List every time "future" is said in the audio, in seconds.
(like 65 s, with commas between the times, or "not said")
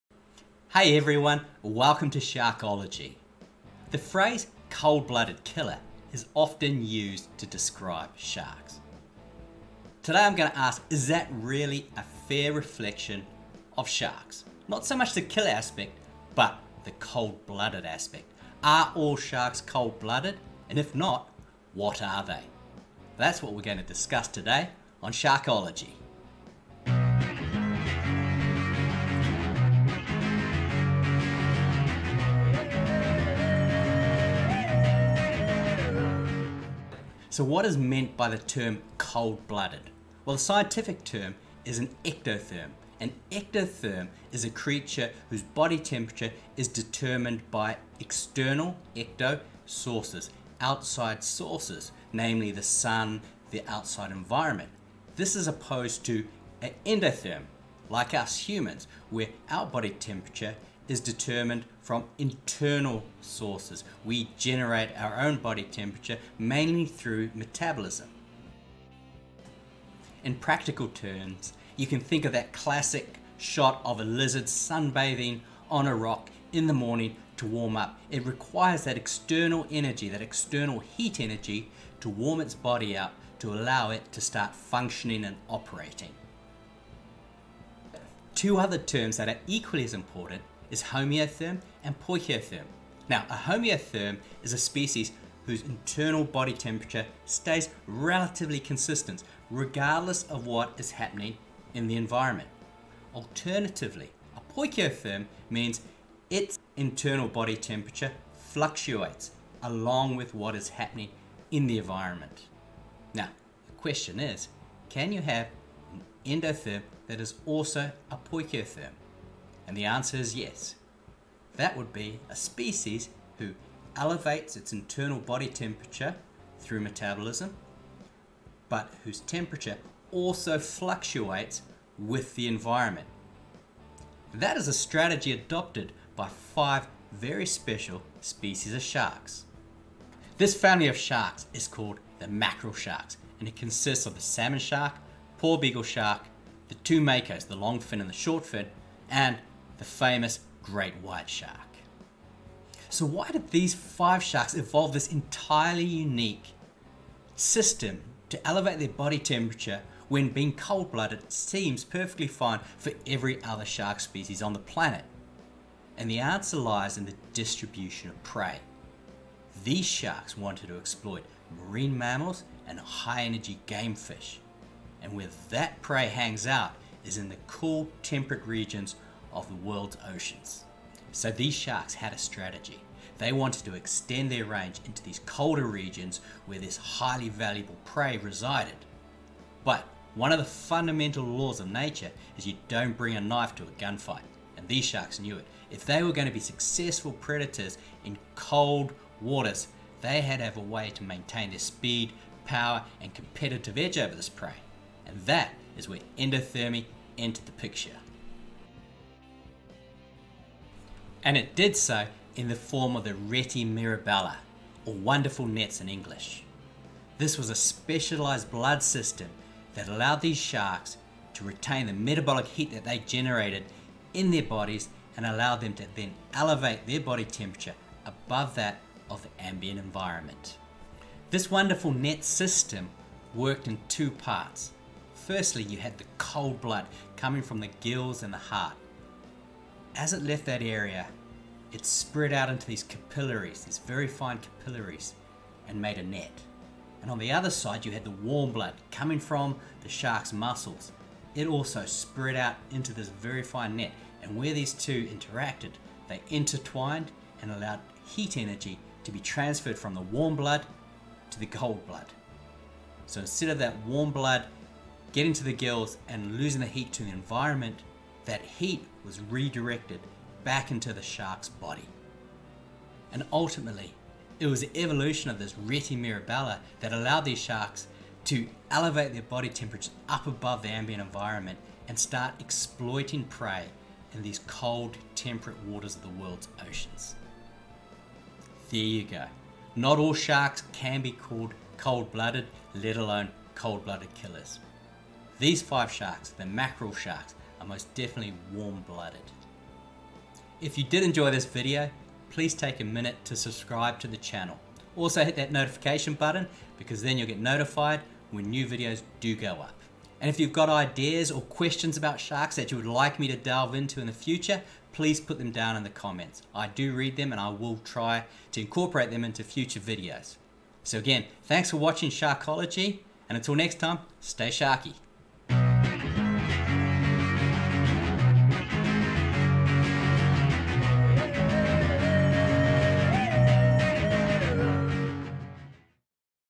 314 s, 319 s.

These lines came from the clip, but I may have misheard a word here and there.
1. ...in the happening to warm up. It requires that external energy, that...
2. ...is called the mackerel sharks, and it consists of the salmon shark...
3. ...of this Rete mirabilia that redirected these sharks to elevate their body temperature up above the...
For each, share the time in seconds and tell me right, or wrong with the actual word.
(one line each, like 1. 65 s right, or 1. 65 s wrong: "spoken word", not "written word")
1. 76 s wrong: "morning", not "happening"
2. 141 s right
3. 275 s wrong: "allowed", not "redirected".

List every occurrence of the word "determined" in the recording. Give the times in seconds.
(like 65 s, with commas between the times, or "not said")
46 s, 60 s.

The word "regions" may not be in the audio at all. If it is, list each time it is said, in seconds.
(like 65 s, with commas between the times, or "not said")
178 s, 185 s.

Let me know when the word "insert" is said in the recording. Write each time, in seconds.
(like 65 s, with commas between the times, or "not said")
not said.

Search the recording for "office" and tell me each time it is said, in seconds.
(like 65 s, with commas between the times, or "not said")
not said.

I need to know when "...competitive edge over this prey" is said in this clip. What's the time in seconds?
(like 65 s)
203 s.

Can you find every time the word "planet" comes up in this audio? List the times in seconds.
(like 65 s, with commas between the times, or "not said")
164 s.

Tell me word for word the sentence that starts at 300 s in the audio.
If you did enjoy this video, please take a minute to subscribe to the channel.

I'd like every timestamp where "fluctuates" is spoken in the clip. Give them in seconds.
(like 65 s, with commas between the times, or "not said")
108 s, 130 s.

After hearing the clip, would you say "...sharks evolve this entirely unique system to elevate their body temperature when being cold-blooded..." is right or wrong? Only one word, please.
right.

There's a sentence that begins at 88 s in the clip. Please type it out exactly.
Two other terms that are equally as important is homeotherm and poikilotherm.